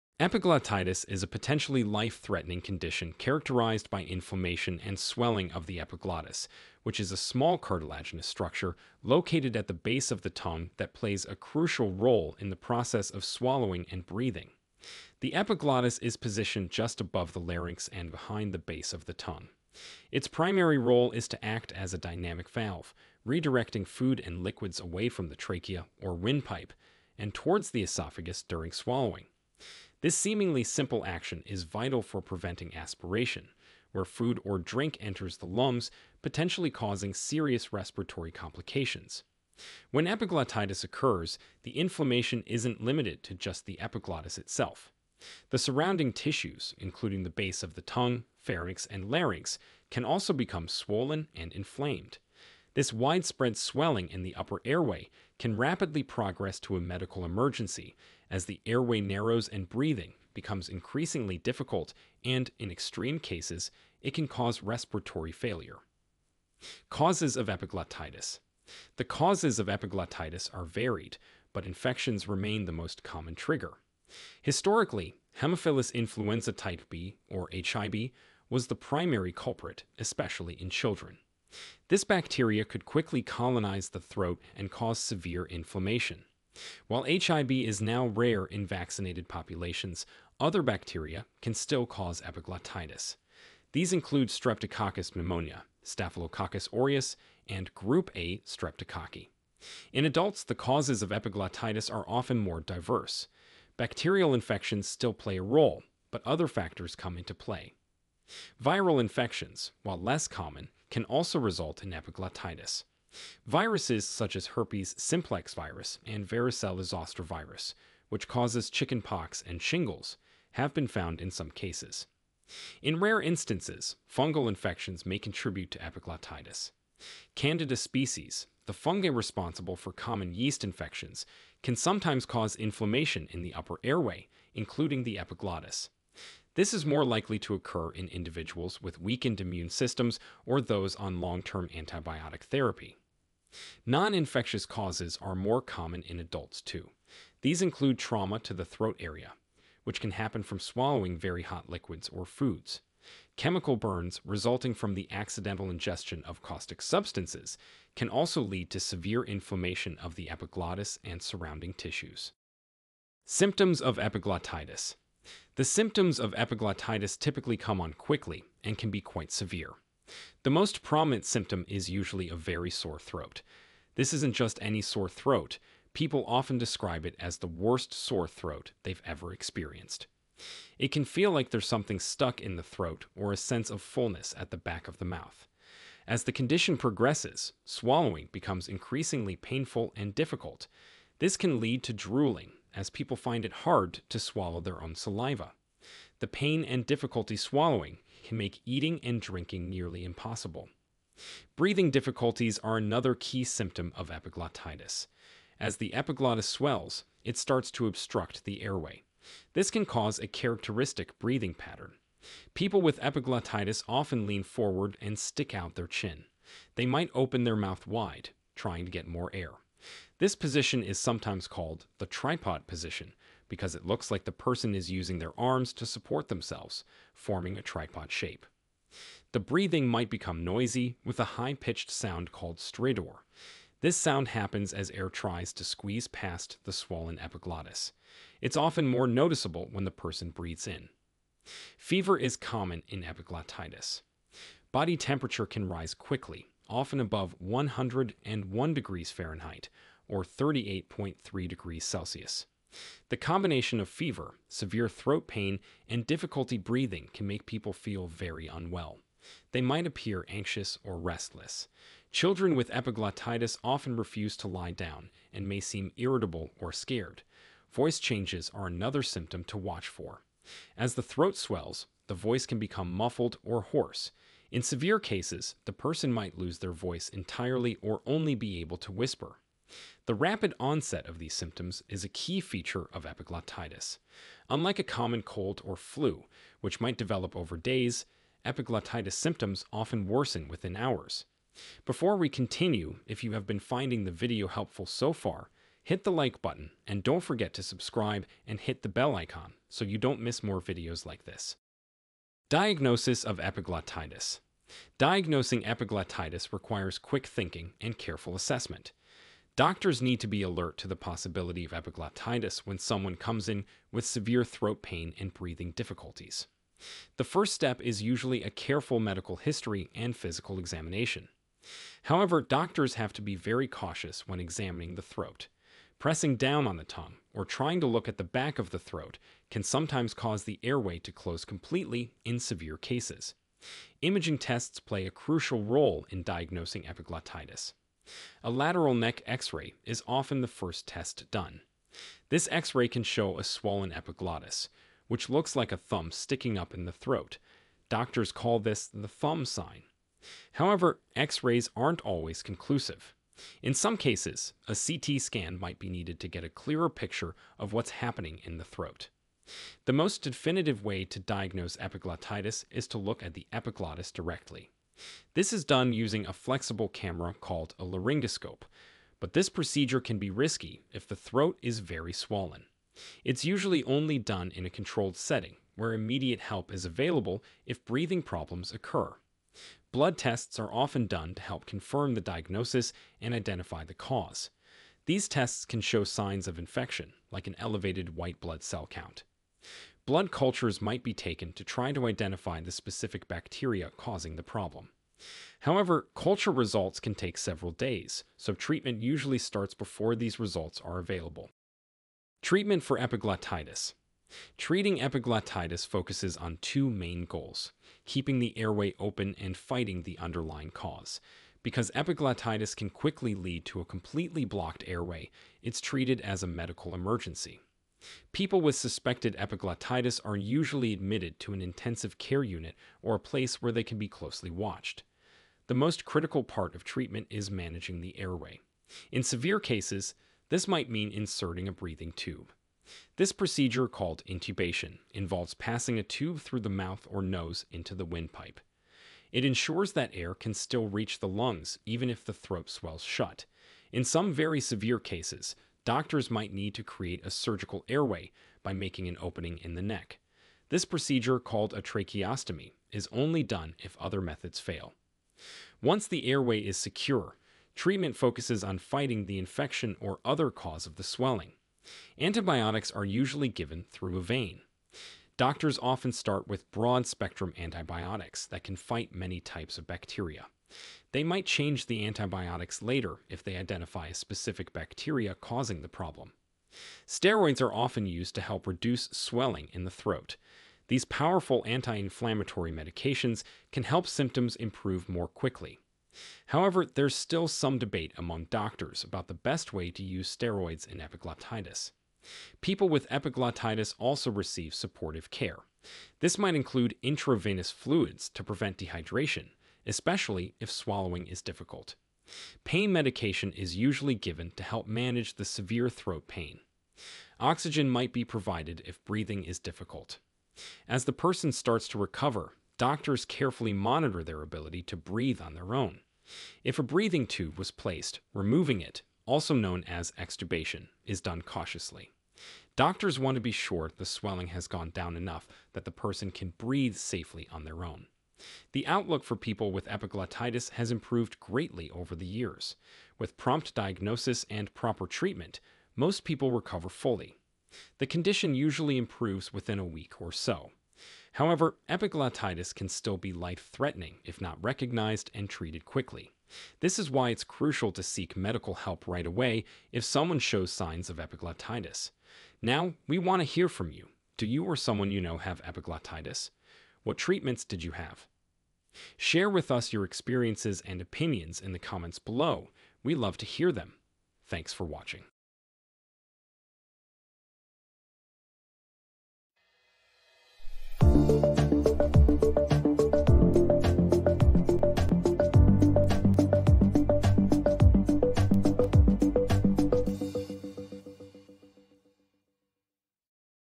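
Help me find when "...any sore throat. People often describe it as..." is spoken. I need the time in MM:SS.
02:54.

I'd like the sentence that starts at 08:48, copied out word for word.
The outlook for people with epiglottitis has improved greatly over the years.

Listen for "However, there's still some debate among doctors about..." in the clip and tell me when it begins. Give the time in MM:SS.
08:06.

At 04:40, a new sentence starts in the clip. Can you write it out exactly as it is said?
The rapid onset of these symptoms is a key feature of epiglottitis.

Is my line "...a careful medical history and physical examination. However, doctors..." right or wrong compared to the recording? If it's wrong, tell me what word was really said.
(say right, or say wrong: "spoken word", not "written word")
right.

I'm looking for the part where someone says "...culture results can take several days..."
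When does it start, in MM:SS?
06:36.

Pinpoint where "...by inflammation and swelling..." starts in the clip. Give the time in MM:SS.
00:03.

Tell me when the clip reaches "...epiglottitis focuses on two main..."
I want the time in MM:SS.
06:45.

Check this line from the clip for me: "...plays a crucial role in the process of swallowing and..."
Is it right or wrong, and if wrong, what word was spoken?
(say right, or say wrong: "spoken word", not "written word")
right.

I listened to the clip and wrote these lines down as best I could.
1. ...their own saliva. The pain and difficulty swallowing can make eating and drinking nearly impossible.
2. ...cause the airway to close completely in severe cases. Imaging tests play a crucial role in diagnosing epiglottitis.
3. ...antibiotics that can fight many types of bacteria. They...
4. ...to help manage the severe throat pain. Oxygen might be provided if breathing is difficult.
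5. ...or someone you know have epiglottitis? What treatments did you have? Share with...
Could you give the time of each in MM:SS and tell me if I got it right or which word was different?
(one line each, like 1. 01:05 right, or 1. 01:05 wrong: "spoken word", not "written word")
1. 03:14 right
2. 05:30 right
3. 07:47 right
4. 08:24 right
5. 09:14 right.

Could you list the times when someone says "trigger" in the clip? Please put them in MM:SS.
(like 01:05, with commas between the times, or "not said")
01:13.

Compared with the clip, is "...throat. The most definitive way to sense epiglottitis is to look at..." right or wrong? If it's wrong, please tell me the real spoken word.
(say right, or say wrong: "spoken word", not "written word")
wrong: "diagnose", not "sense".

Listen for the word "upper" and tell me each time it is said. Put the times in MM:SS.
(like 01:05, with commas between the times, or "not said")
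00:54, 02:13.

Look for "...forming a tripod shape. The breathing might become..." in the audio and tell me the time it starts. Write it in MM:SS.
03:47.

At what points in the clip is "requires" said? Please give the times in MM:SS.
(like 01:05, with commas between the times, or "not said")
05:06.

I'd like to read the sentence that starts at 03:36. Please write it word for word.
They might open their mouth wide, trying to get more air.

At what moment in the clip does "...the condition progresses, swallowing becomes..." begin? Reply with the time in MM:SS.
03:06.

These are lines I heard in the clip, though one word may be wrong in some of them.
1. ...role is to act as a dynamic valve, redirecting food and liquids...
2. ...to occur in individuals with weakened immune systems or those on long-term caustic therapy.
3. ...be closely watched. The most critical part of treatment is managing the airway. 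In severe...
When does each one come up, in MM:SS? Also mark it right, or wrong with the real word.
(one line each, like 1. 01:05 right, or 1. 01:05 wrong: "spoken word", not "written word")
1. 00:20 right
2. 02:17 wrong: "antibiotic", not "caustic"
3. 07:03 right.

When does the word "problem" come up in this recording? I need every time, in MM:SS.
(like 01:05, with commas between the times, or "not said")
06:18, 06:34, 07:55.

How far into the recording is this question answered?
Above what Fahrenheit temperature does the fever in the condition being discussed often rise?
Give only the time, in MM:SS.
04:07.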